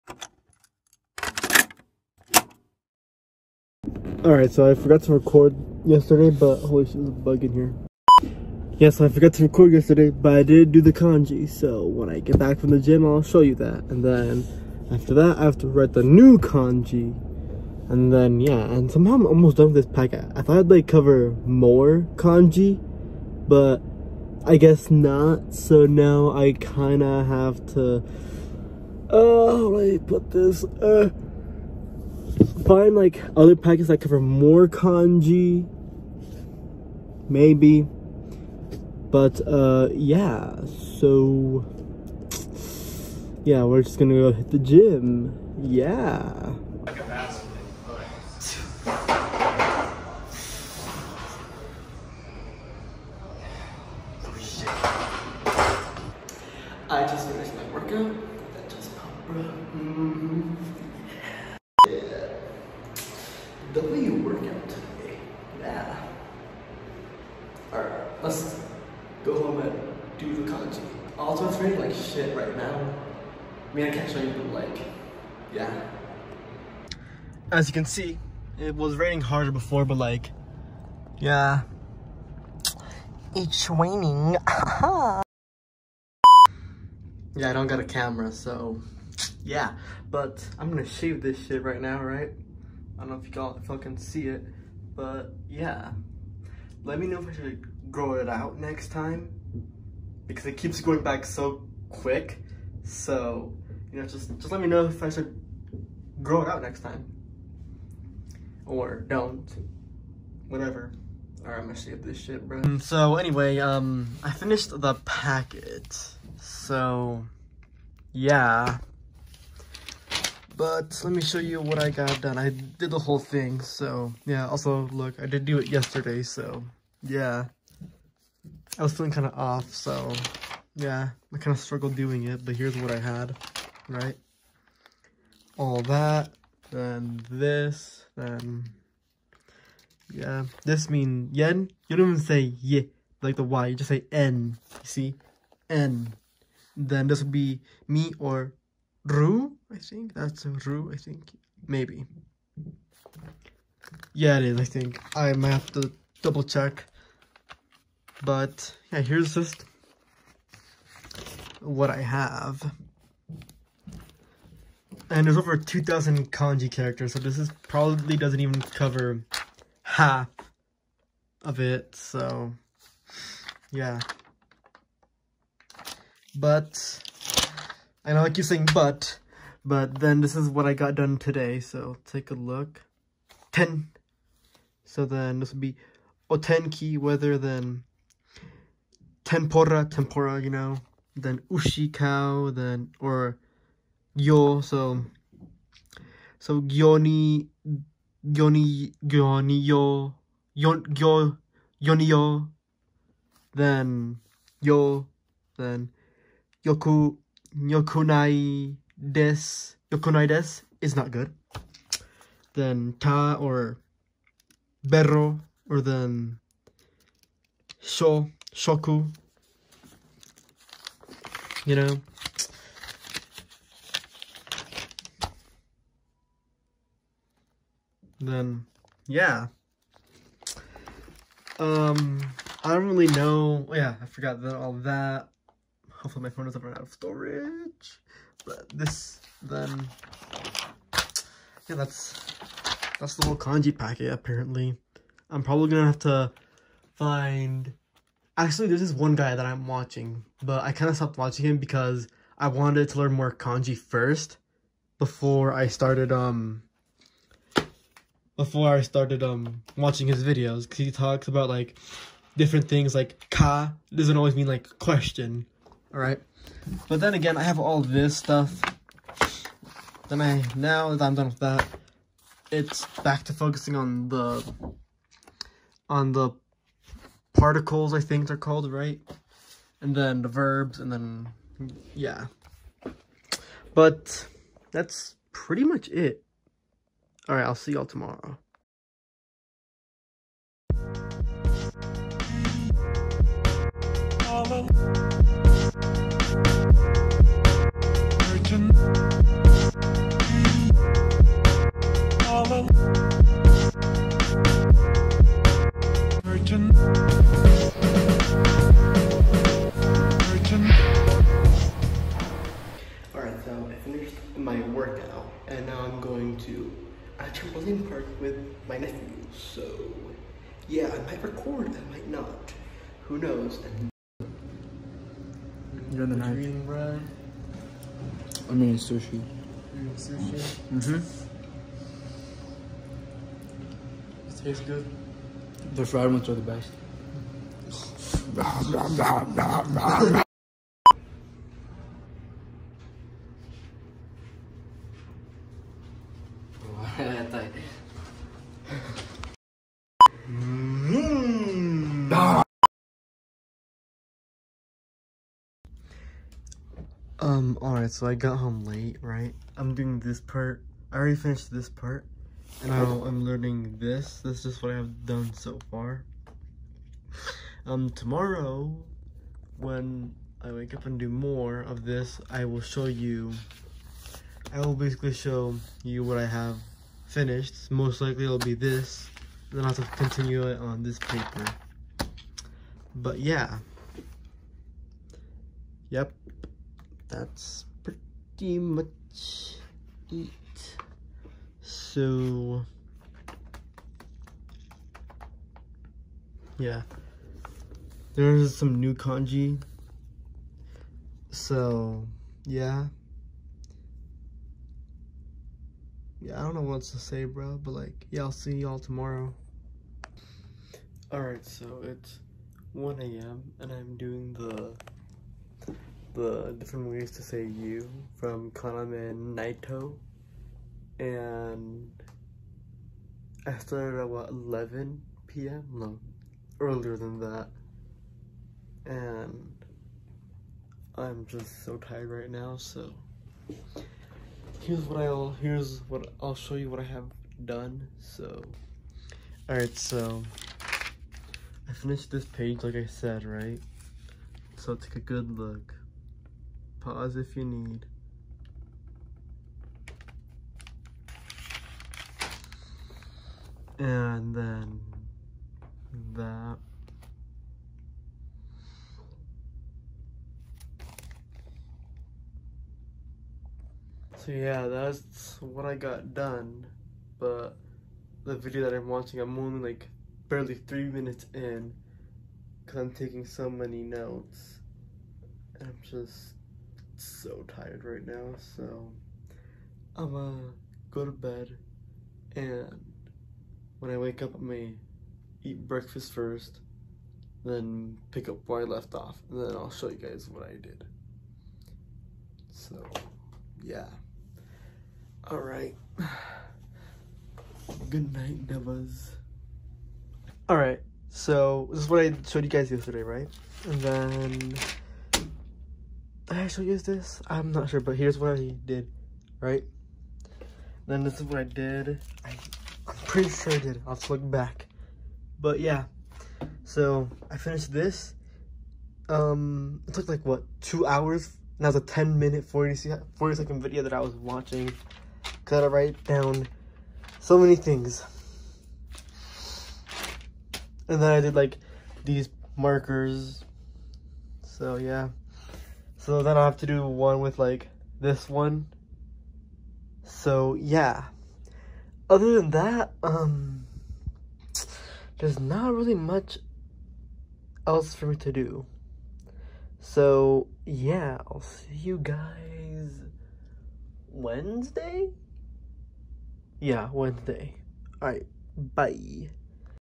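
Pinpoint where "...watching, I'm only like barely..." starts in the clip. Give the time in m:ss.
7:48.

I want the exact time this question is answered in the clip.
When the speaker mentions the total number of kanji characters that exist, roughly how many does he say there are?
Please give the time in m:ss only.
2:45.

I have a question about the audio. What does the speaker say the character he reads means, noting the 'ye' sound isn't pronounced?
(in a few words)
yen.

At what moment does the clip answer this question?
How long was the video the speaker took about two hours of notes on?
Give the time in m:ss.
8:41.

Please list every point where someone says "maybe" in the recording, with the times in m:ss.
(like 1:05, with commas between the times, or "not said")
0:37, 2:31.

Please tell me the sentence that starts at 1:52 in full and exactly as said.
Mm, so anyway, um, I finished the packet.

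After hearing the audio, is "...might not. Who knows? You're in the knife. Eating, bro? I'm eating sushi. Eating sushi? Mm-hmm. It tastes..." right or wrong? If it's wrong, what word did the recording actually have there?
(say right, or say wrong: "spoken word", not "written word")
right.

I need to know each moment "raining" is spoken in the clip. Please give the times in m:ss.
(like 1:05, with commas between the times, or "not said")
1:18, 1:23.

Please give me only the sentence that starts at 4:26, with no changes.
But then again, I have all this stuff.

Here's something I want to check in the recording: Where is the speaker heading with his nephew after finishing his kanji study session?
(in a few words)
a trampoline park.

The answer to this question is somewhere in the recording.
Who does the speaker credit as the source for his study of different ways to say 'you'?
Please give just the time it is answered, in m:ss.
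6:58.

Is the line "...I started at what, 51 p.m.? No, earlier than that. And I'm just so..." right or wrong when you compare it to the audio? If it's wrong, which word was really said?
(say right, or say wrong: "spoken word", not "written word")
wrong: "11", not "51".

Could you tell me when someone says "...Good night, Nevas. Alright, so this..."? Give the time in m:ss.
8:17.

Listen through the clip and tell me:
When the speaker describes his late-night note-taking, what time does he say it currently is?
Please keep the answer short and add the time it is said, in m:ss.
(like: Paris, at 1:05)
1 a.m., at 6:52.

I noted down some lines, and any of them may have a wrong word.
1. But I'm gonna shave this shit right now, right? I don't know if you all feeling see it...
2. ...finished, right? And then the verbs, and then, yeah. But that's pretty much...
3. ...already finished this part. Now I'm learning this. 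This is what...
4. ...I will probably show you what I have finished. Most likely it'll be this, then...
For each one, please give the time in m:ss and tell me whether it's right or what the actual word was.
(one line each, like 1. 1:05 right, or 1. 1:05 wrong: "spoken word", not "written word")
1. 1:30 wrong: "fucking", not "feeling"
2. 4:38 wrong: "called", not "finished"
3. 6:00 right
4. 6:14 wrong: "basically", not "probably".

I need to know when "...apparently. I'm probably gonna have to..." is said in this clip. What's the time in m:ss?
4:04.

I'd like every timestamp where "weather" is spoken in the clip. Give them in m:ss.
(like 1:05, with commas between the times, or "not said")
3:06.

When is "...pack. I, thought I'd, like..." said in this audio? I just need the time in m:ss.
0:19.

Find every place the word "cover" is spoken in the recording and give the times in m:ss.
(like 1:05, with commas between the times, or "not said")
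0:20, 0:34, 2:48.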